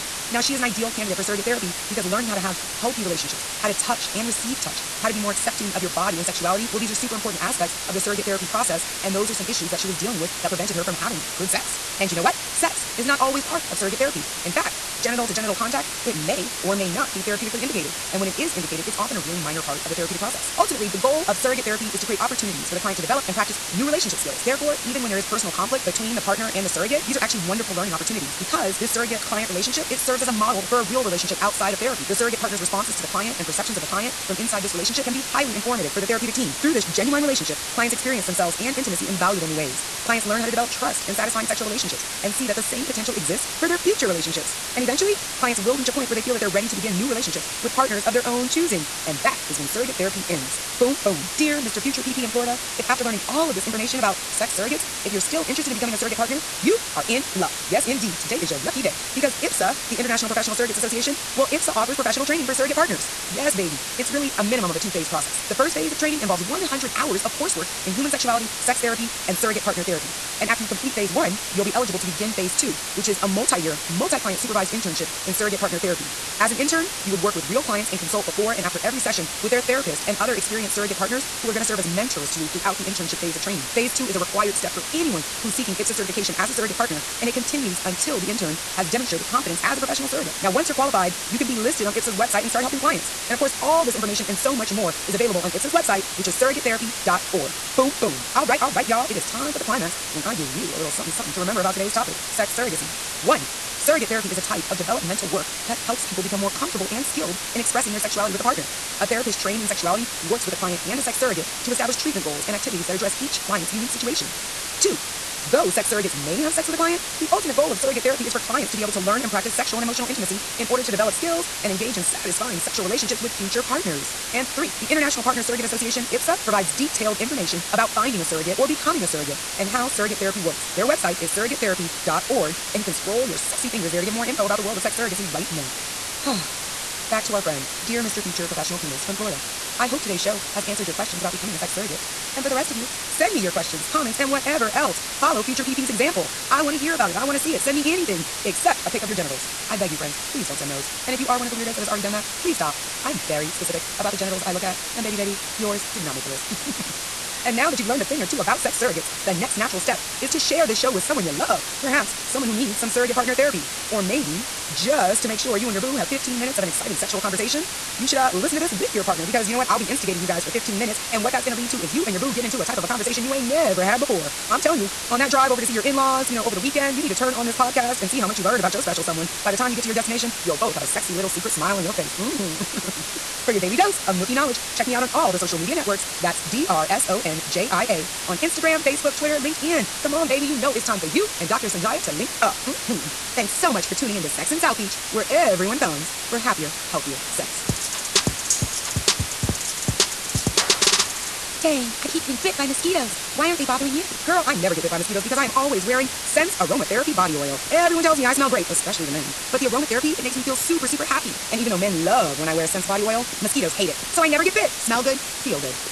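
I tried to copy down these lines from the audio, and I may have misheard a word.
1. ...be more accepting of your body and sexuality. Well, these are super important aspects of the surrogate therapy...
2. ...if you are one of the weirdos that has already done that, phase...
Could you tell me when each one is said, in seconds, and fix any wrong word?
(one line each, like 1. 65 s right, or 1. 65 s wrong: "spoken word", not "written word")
1. 5 s right
2. 151 s wrong: "please", not "phase".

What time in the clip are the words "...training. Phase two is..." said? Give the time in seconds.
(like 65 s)
83 s.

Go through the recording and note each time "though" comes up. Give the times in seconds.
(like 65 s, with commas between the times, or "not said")
115 s, 211 s.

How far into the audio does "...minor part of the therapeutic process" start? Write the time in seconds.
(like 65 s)
19 s.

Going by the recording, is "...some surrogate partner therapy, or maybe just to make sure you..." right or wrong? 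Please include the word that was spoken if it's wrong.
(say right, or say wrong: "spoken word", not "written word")
right.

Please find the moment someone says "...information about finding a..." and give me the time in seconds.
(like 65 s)
127 s.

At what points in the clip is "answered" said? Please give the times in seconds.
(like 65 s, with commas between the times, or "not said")
140 s.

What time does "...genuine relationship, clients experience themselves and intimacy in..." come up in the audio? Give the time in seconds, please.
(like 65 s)
36 s.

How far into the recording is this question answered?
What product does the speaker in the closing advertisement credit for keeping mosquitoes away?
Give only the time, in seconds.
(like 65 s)
206 s.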